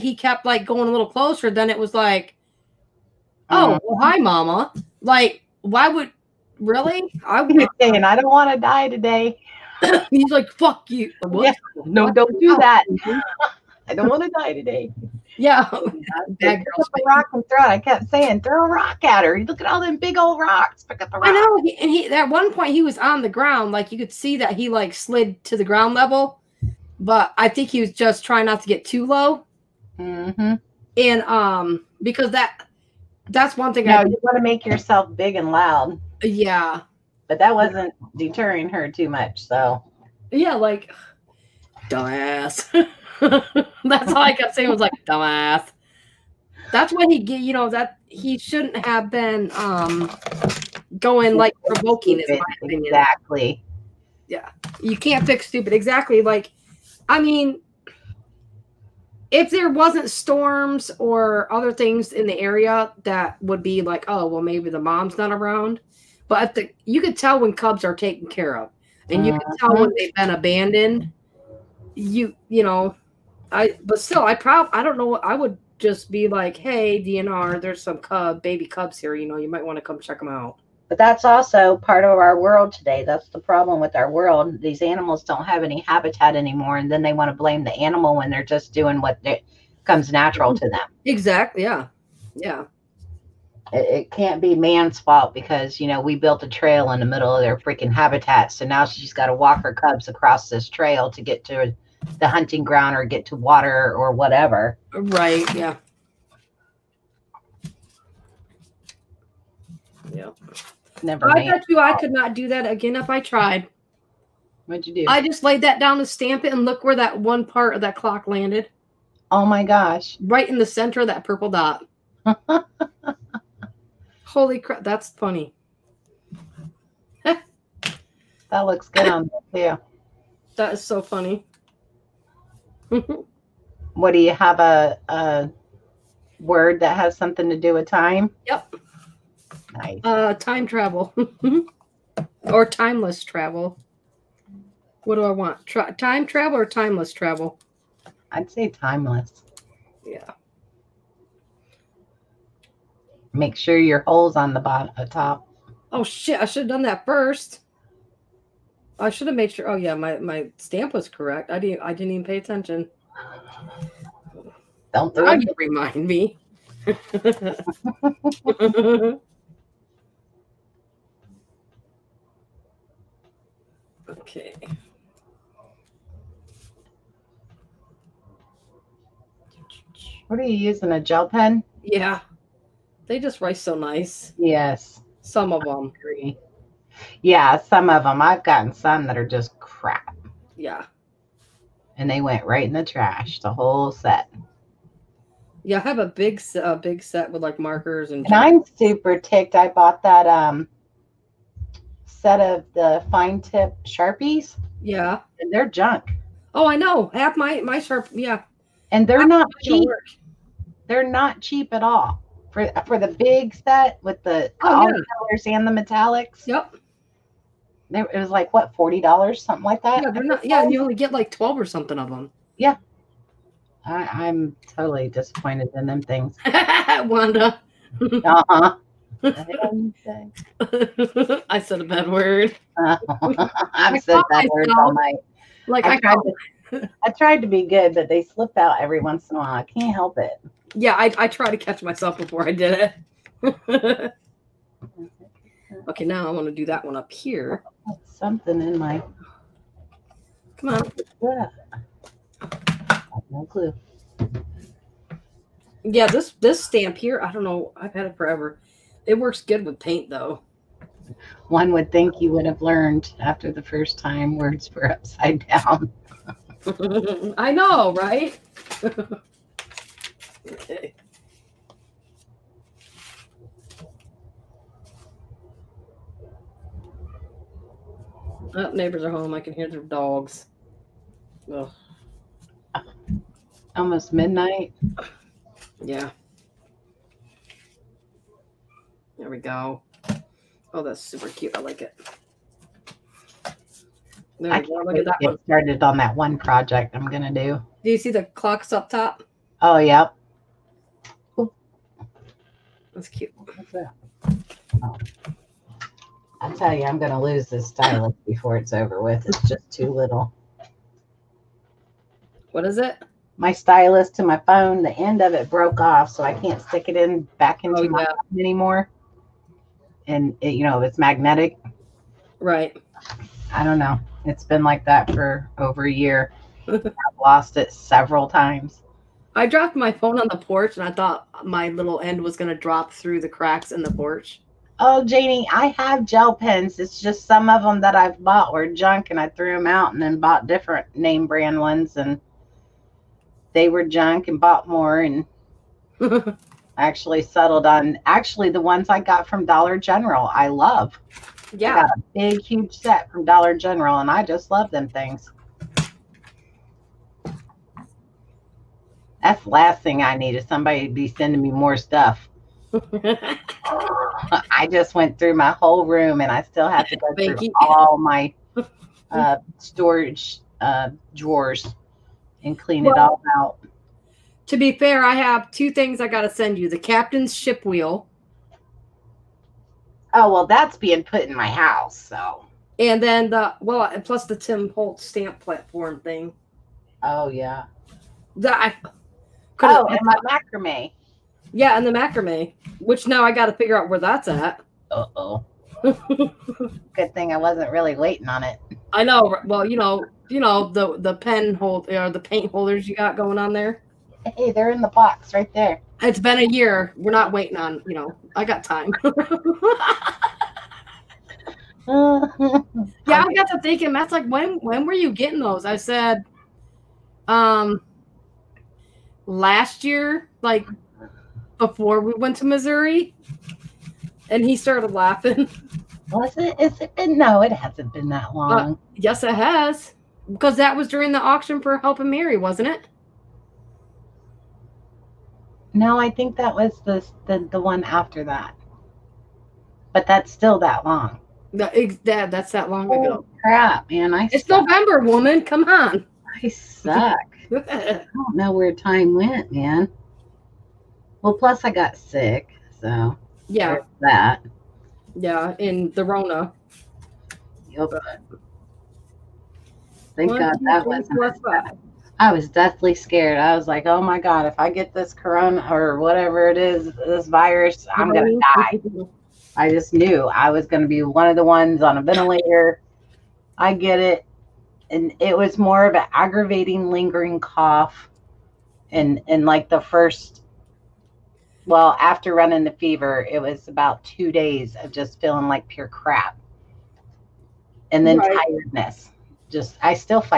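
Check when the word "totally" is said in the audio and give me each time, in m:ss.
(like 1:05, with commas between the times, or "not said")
3:44.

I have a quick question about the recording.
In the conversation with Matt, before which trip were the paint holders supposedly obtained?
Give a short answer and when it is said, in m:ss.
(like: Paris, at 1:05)
Missouri, at 7:02.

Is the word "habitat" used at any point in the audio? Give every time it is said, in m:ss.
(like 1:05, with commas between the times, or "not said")
1:25, 1:37.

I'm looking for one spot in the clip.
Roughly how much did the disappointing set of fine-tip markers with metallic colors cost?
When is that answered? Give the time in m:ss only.
3:38.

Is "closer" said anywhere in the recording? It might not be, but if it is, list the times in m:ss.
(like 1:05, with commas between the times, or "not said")
0:01.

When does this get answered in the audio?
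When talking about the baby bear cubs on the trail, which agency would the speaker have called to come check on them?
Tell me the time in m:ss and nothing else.
1:17.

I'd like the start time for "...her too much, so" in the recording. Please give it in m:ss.
0:38.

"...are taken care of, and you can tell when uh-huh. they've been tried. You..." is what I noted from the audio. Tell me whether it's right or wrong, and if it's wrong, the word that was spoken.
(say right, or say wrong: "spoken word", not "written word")
wrong: "abandoned", not "tried".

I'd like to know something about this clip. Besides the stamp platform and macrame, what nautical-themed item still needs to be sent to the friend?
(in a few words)
Captain's ship wheel.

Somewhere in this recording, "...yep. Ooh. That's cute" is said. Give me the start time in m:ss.
4:59.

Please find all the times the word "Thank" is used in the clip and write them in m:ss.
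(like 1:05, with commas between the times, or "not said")
6:07, 7:40.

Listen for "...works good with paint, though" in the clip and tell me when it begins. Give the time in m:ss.
4:19.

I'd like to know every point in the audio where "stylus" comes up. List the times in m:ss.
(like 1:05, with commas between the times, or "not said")
5:07, 5:13.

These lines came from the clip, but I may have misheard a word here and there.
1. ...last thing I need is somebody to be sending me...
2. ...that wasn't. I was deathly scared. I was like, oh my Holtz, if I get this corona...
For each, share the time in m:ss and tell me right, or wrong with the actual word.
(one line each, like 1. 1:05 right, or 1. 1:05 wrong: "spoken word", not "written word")
1. 5:59 right
2. 7:40 wrong: "God", not "Holtz".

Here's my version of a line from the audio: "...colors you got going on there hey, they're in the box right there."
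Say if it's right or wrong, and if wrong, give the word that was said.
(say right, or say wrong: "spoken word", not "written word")
wrong: "holders", not "colors".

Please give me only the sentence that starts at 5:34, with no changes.
Oh, Janie, I have gel pens.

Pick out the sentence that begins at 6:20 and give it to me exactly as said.
Oh, well, that's being put in my house.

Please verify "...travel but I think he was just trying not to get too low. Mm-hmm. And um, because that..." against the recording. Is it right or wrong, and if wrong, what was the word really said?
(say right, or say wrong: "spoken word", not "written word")
wrong: "level", not "travel".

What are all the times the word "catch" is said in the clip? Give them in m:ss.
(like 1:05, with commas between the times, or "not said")
4:01.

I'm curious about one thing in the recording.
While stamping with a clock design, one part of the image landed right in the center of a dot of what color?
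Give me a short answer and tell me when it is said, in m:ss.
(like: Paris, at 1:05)
Purple, at 2:01.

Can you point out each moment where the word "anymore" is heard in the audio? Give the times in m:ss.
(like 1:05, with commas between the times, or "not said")
1:26, 5:18.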